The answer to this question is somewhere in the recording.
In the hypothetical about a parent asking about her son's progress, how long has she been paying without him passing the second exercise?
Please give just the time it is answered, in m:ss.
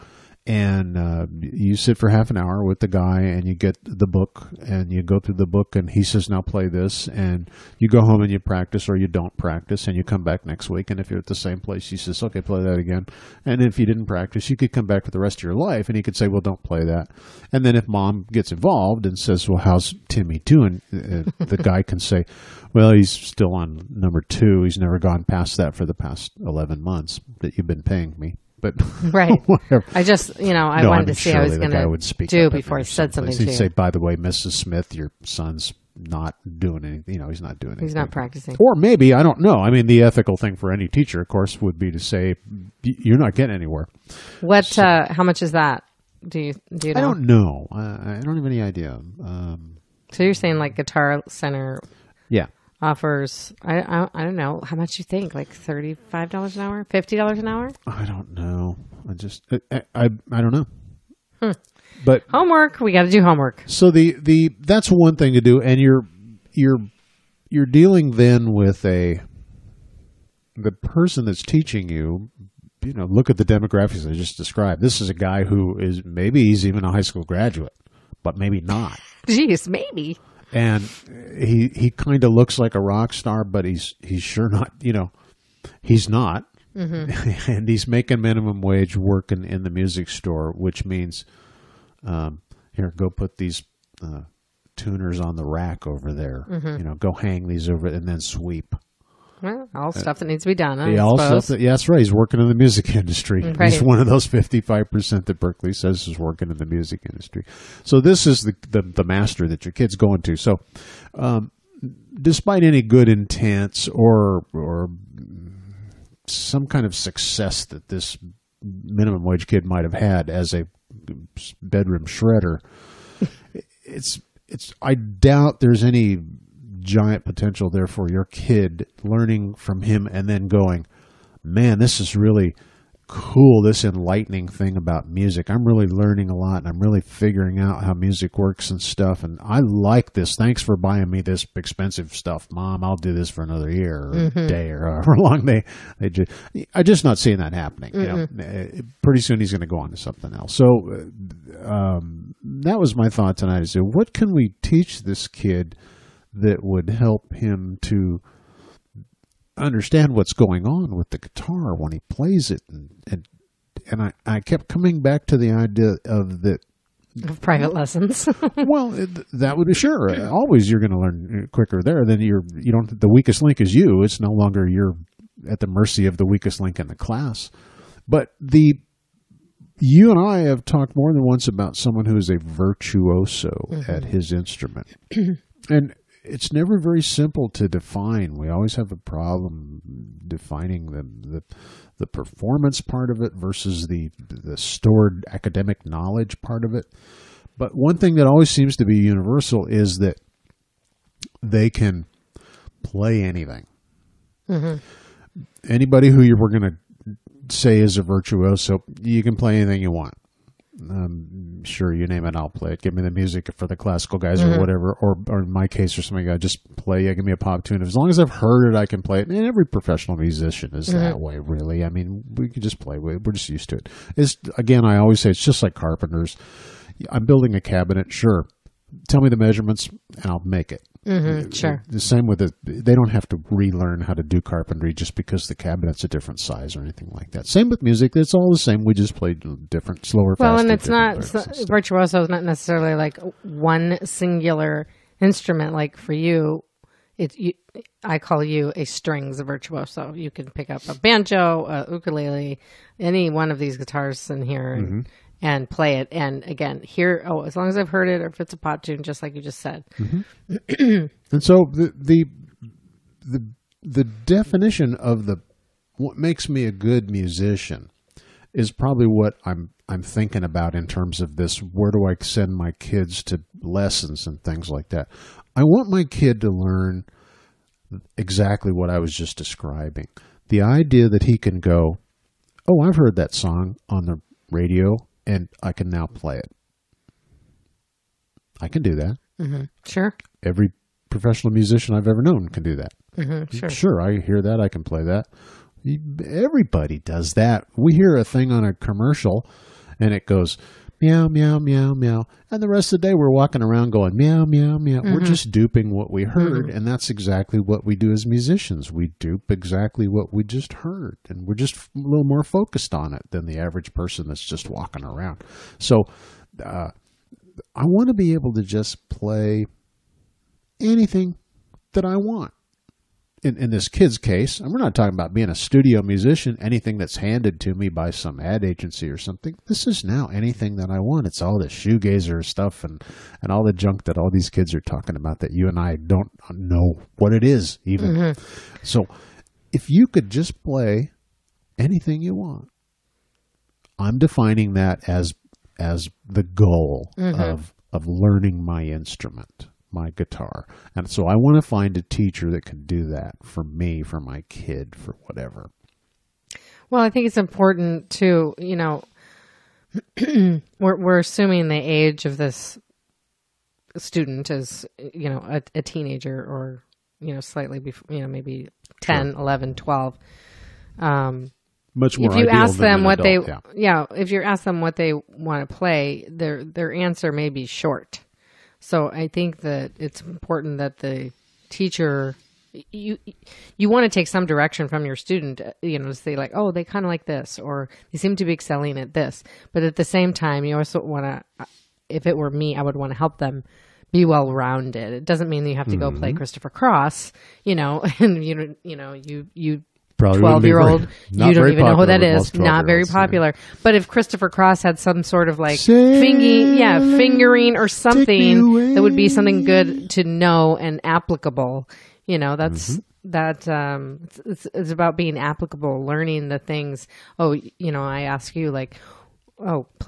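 0:26.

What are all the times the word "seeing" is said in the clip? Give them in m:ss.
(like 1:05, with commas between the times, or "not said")
2:27.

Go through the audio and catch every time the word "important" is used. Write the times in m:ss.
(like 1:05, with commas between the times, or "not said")
5:57, 6:20.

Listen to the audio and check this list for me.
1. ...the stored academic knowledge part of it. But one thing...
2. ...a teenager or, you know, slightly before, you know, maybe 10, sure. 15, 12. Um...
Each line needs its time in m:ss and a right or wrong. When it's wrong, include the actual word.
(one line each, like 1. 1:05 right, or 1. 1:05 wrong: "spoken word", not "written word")
1. 3:14 right
2. 6:05 wrong: "11", not "15".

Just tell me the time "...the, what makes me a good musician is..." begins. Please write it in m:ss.
4:25.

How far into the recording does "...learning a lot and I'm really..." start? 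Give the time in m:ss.
2:15.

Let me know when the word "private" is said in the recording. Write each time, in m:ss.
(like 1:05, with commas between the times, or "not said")
2:47.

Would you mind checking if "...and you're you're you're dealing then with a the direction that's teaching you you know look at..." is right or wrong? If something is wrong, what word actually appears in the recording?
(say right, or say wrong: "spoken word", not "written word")
wrong: "person", not "direction".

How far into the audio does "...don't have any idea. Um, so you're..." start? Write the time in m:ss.
0:48.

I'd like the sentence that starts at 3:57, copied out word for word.
Same with music; it's all the same.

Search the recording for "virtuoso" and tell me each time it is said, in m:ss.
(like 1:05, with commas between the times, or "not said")
3:02, 3:28, 4:01, 4:09.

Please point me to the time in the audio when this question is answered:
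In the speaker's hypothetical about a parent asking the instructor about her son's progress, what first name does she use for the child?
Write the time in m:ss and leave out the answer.
0:20.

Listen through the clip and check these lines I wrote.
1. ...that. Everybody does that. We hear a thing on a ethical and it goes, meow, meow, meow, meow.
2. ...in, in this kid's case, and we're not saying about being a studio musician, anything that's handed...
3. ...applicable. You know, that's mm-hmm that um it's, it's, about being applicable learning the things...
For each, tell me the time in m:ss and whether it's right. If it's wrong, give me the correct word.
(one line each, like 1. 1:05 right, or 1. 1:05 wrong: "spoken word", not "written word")
1. 4:55 wrong: "commercial", not "ethical"
2. 5:23 wrong: "talking", not "saying"
3. 6:51 right.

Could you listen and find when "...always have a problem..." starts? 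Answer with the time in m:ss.
3:08.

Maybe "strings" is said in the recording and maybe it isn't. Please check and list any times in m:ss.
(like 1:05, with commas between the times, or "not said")
4:08.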